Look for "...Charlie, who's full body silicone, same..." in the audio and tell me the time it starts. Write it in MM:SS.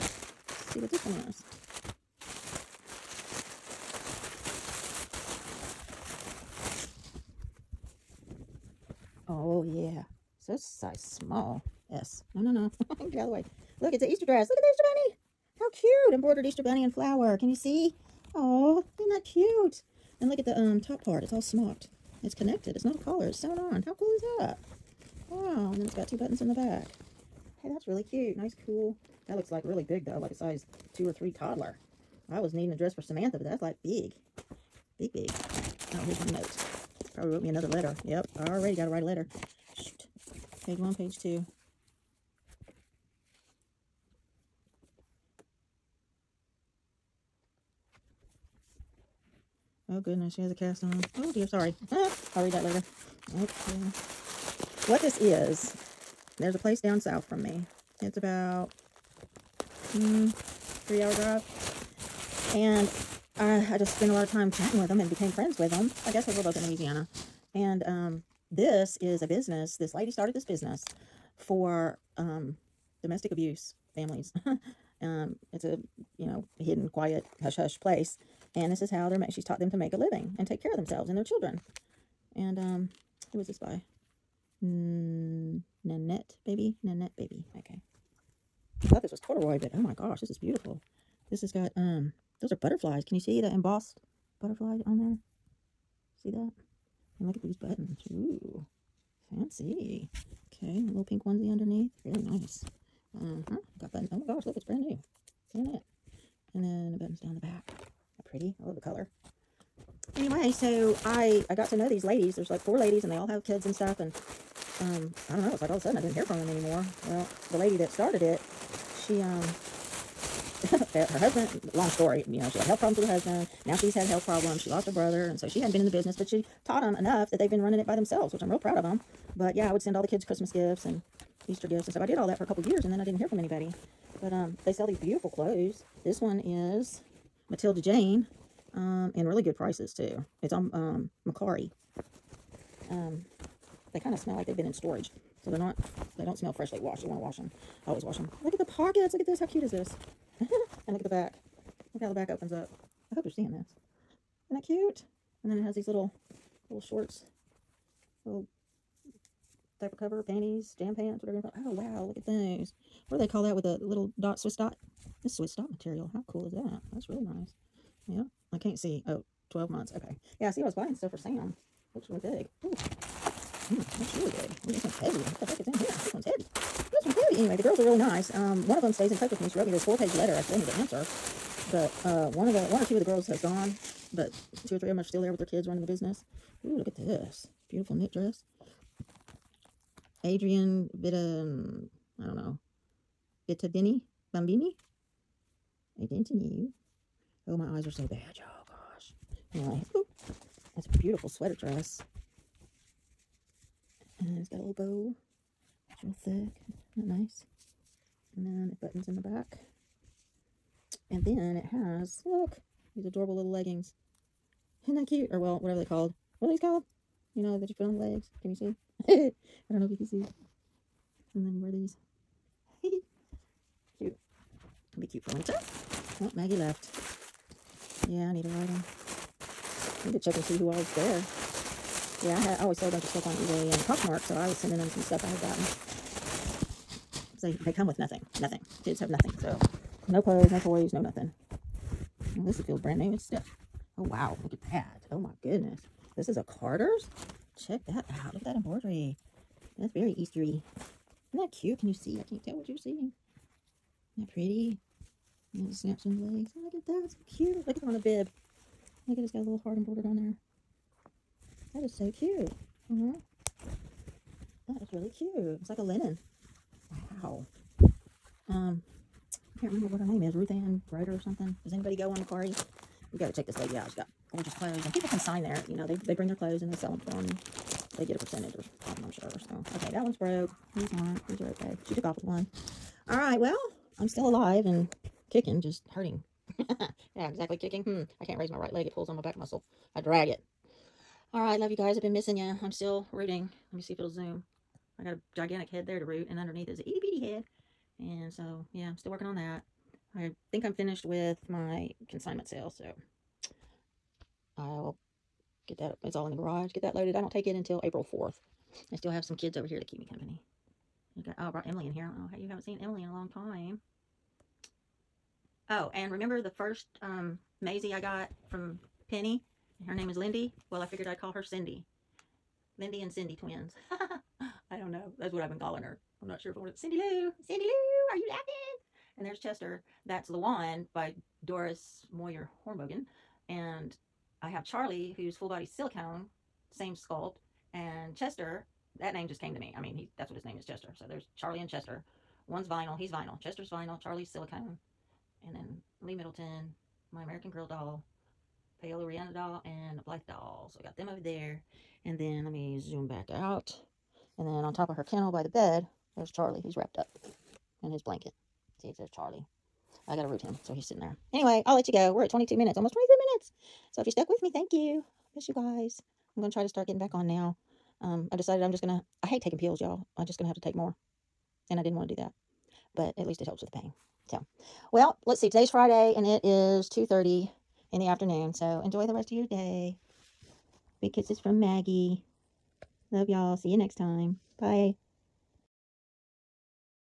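05:34.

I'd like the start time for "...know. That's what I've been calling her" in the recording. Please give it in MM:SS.
05:24.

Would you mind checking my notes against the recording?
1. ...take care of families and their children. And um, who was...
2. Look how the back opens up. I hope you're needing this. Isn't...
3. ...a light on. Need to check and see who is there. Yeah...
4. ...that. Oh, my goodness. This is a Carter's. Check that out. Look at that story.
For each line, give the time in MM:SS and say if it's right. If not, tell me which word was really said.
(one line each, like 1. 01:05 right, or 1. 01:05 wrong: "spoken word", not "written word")
1. 01:20 wrong: "themselves", not "families"
2. 02:31 wrong: "seeing", not "needing"
3. 03:48 right
4. 04:04 wrong: "embroidery", not "story".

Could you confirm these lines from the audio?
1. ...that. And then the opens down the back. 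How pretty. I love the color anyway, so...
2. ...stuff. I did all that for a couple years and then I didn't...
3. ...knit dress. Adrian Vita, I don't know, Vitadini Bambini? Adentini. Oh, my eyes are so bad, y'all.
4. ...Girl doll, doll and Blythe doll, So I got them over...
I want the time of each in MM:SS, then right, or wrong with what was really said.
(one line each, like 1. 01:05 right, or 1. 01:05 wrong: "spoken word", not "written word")
1. 01:45 wrong: "buttons", not "opens"
2. 02:11 right
3. 03:07 right
4. 05:47 right.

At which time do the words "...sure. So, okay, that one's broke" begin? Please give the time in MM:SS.
04:39.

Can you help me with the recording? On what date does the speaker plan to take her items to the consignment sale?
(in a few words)
April 4th.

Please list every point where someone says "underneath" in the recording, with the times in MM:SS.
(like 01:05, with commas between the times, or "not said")
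01:41, 04:56.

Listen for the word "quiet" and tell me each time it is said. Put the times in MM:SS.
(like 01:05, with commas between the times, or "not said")
01:16.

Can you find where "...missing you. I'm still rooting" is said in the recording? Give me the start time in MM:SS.
04:52.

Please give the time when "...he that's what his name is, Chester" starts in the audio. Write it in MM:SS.
05:39.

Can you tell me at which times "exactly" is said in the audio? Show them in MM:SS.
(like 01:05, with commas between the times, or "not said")
04:47.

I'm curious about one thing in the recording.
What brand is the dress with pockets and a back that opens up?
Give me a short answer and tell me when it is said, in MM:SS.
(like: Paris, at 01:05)
Matilda Jane, at 02:17.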